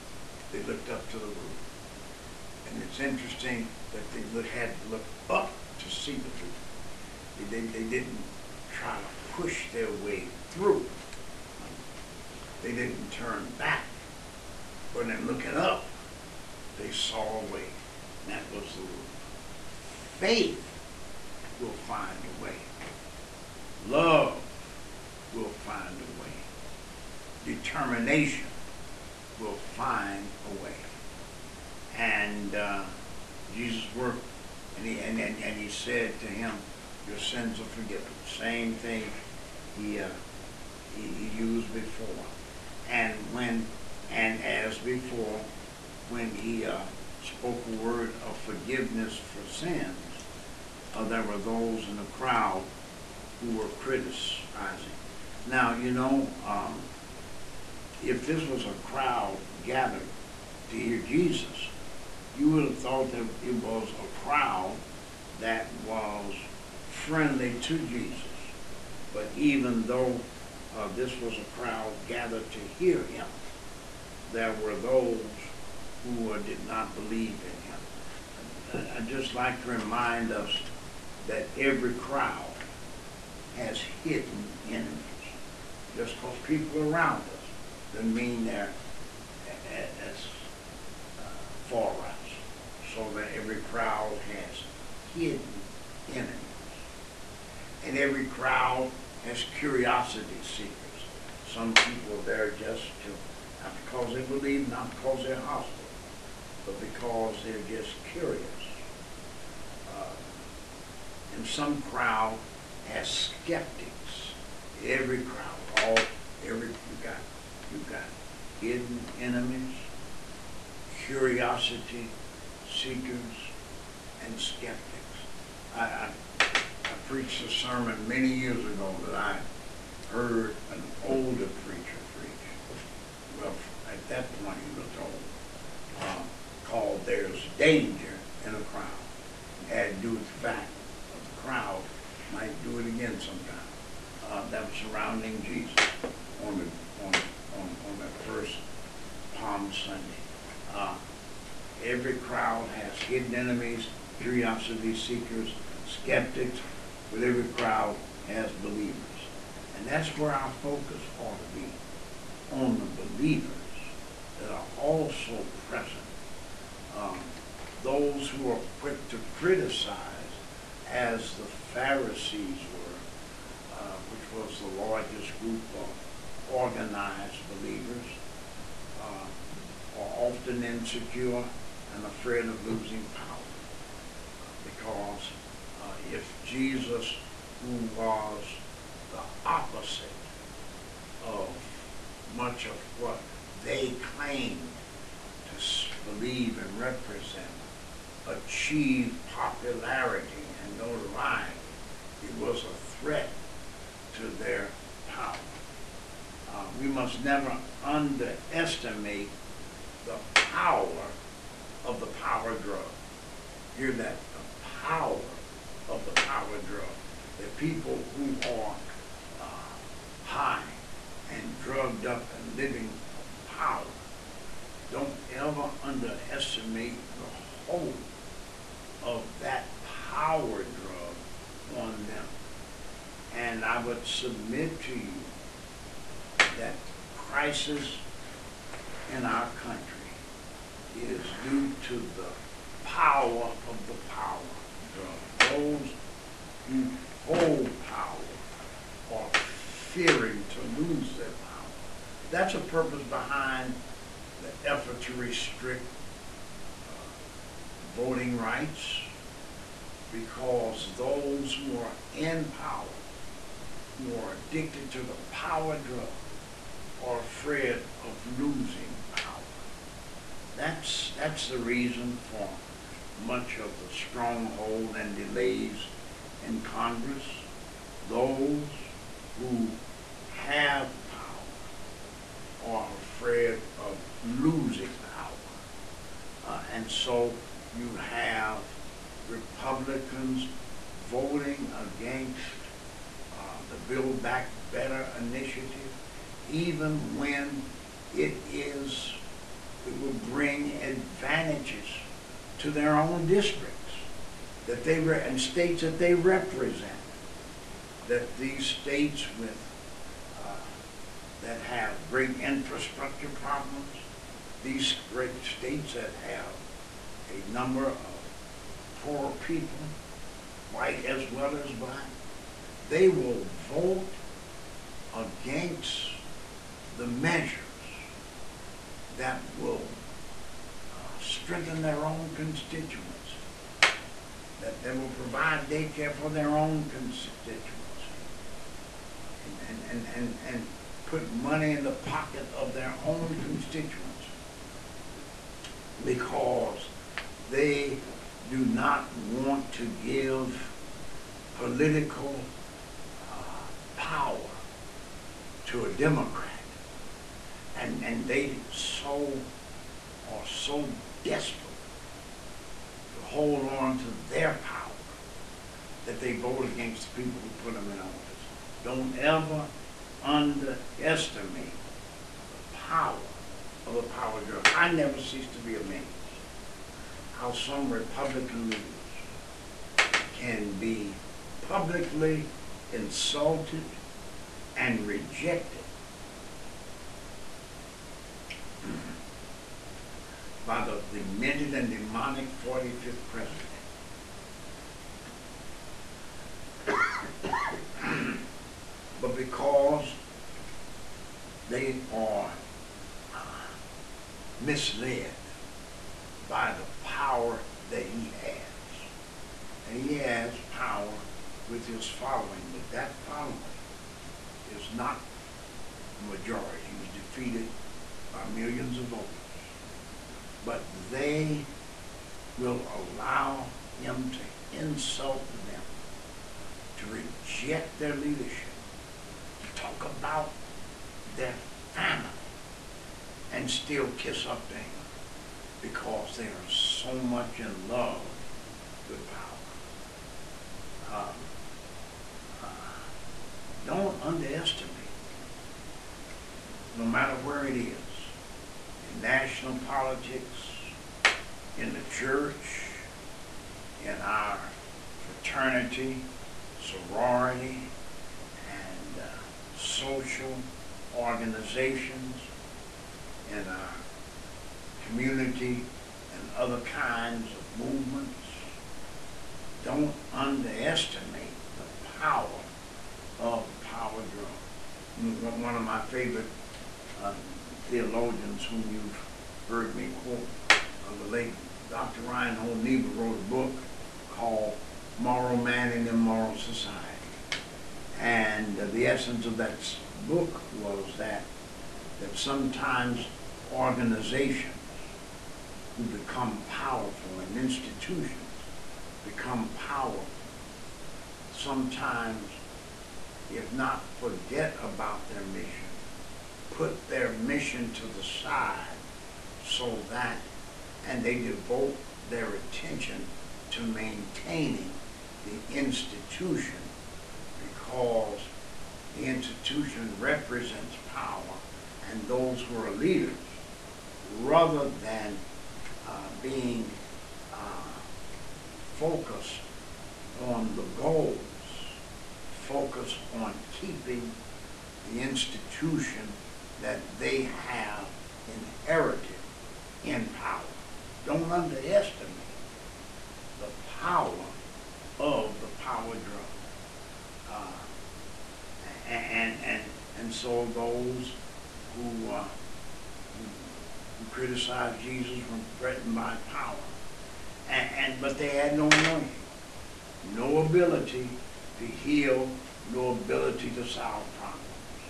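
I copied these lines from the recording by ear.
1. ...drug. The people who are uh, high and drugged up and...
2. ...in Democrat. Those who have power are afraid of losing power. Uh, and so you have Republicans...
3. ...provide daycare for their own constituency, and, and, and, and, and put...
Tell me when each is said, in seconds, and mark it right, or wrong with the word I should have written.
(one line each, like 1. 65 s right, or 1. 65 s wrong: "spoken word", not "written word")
1. 216 s right
2. 276 s wrong: "Congress", not "Democrat"
3. 335 s right.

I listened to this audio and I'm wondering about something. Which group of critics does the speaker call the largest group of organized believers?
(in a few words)
The Pharisees.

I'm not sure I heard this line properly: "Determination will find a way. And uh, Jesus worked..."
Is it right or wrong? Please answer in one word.
right.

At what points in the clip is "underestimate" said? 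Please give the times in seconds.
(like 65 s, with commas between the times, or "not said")
207 s, 225 s, 370 s, 444 s, 470 s, 541 s.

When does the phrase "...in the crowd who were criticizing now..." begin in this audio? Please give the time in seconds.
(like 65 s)
51 s.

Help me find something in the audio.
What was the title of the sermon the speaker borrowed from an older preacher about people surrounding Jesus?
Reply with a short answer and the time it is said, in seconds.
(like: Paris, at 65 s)
There's Danger in a Crowd, at 137 s.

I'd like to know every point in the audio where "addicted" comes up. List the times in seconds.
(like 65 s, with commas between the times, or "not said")
264 s.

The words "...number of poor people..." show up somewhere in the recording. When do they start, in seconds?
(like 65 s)
317 s.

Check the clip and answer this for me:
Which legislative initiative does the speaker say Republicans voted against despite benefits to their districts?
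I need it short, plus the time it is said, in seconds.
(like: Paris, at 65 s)
Build Back Better, at 293 s.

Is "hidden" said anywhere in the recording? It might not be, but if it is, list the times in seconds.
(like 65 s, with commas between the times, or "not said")
83 s, 95 s, 118 s, 152 s.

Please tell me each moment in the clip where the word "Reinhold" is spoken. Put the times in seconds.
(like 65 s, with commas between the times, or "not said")
482 s.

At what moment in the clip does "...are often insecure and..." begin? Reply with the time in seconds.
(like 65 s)
179 s.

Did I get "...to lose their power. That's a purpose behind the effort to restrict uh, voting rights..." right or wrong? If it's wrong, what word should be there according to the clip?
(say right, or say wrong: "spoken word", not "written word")
right.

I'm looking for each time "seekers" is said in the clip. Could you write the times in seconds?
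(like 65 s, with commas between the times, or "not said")
100 s, 122 s, 154 s.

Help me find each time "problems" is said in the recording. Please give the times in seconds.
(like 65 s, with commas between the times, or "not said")
313 s, 564 s.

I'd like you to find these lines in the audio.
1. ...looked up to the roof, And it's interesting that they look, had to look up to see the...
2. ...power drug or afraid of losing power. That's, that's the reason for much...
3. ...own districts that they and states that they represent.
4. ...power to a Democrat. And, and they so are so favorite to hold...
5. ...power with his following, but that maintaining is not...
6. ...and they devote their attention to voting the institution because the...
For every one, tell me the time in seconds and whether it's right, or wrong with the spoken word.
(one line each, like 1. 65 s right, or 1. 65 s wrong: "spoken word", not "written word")
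1. 0 s right
2. 265 s right
3. 302 s right
4. 353 s wrong: "desperate", not "favorite"
5. 410 s wrong: "following", not "maintaining"
6. 511 s wrong: "maintaining", not "voting".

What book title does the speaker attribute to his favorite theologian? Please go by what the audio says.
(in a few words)
Moral Man in the Moral Society.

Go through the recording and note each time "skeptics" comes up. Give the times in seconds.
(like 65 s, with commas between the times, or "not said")
113 s, 124 s, 155 s.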